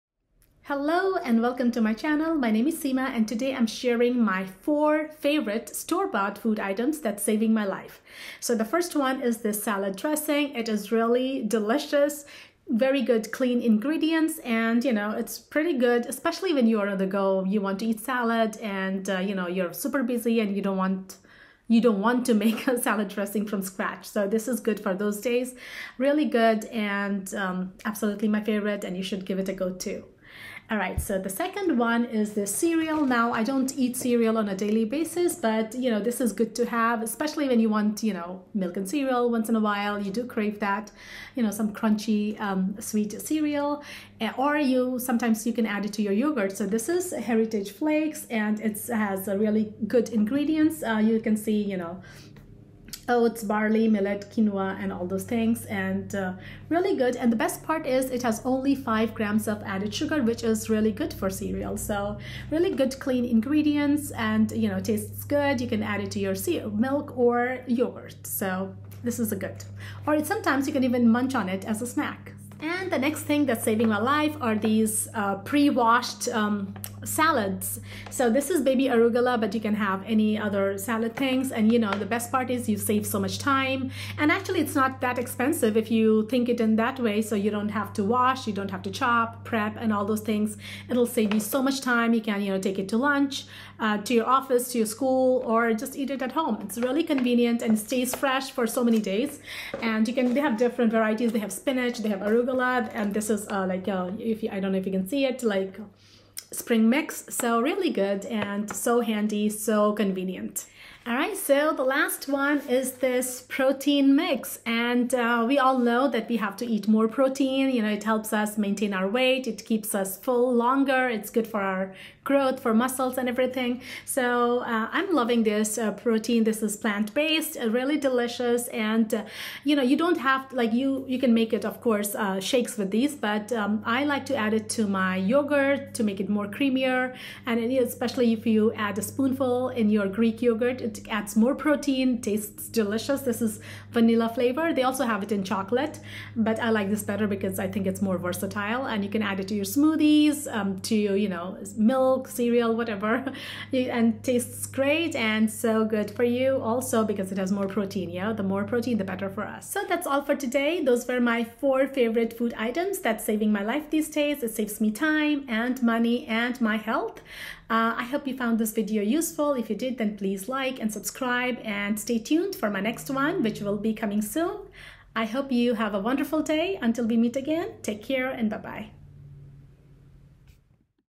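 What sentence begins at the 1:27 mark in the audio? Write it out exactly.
So you don't have to wash, you don't have to chop, prep, and all those things.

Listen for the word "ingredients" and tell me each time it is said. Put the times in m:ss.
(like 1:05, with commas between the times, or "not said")
0:13, 0:50, 1:03.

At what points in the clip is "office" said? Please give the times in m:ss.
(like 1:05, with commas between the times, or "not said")
1:34.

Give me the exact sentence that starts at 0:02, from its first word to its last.
My name is Seema and today I'm sharing my four favorite store-bought food items that's saving my life.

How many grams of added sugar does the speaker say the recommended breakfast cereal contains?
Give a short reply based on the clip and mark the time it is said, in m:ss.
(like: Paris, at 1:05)
5, at 0:58.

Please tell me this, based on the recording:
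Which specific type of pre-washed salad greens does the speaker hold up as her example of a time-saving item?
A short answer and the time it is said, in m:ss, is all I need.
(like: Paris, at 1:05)
Baby arugula, at 1:18.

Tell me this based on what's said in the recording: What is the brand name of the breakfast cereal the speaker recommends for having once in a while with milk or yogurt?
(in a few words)
Heritage Flakes.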